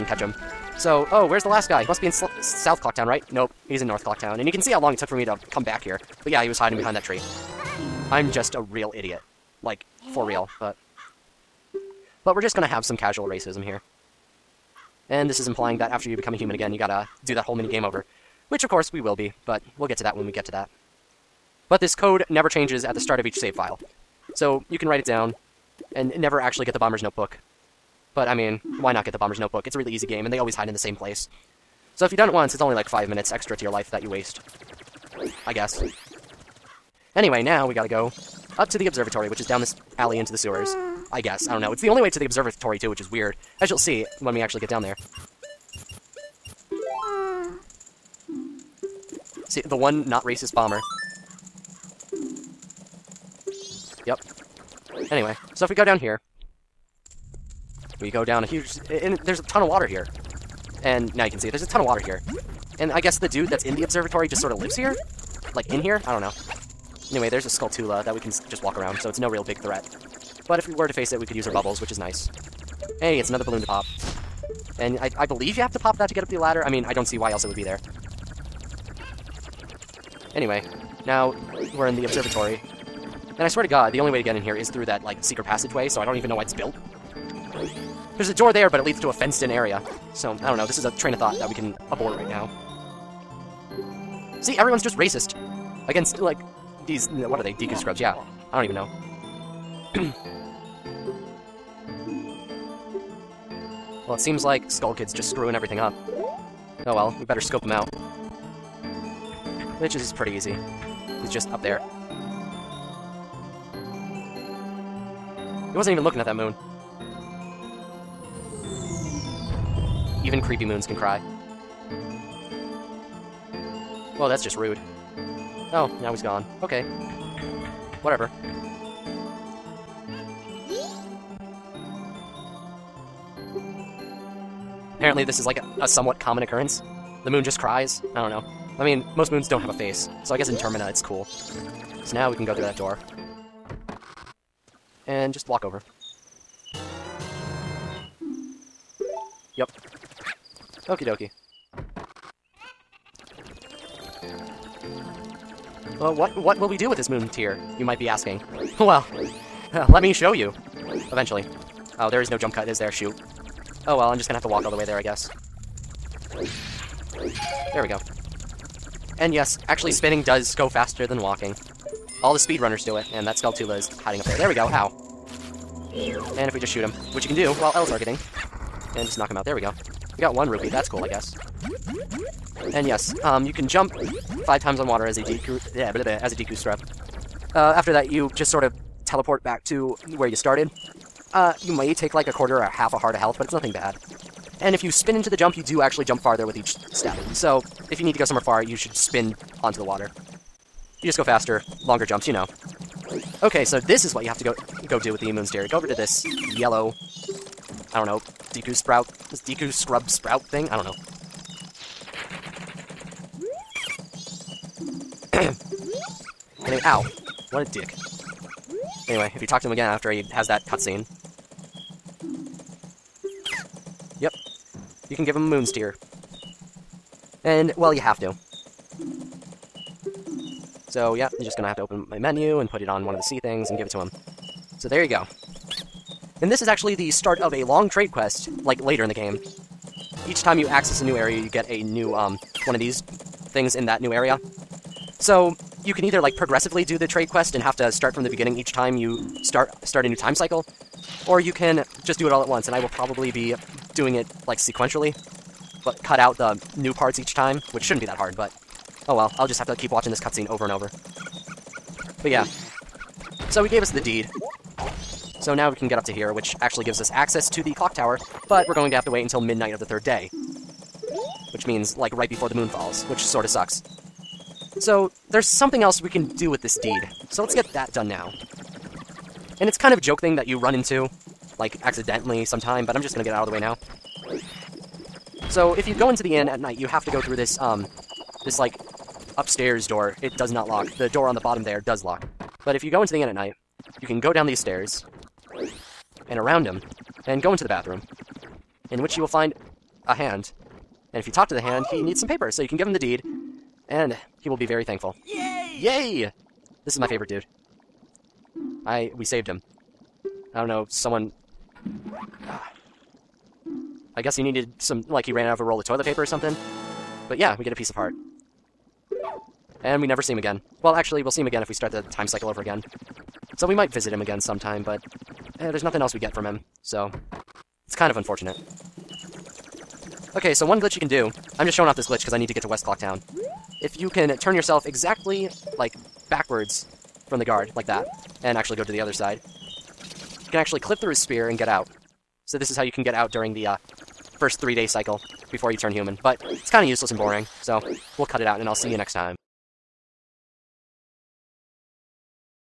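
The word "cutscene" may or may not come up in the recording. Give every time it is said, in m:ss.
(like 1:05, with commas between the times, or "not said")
3:40, 4:20.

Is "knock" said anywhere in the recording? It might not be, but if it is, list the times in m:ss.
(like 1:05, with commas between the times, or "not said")
2:59.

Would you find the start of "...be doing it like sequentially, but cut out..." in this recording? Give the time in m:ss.
4:13.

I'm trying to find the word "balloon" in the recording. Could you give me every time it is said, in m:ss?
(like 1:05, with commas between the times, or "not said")
1:13.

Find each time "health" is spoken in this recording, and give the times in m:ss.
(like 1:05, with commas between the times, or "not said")
3:13.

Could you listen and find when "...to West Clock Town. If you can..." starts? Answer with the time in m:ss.
5:32.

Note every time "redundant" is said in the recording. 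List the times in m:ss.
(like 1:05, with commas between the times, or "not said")
not said.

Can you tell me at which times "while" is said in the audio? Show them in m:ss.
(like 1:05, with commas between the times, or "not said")
2:57.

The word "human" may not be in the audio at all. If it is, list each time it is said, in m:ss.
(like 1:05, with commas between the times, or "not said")
0:16, 5:45.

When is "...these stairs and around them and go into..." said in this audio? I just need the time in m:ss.
4:54.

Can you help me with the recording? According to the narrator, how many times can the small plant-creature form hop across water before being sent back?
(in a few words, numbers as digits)
5.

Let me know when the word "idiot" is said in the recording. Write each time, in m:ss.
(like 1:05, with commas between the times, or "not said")
0:08.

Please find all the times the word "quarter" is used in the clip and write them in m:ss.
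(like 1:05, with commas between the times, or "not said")
3:12.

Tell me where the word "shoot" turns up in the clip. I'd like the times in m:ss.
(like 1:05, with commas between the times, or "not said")
2:42, 2:56.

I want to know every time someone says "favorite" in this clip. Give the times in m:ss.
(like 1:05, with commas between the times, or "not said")
5:07.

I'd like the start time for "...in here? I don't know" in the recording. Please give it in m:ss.
1:05.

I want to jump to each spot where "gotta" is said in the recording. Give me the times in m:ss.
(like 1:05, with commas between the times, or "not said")
0:16, 0:37.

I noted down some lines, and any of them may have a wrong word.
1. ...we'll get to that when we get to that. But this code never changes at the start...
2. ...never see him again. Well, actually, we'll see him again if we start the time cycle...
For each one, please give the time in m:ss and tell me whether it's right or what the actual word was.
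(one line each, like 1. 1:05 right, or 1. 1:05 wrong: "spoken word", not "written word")
1. 0:19 right
2. 5:20 right.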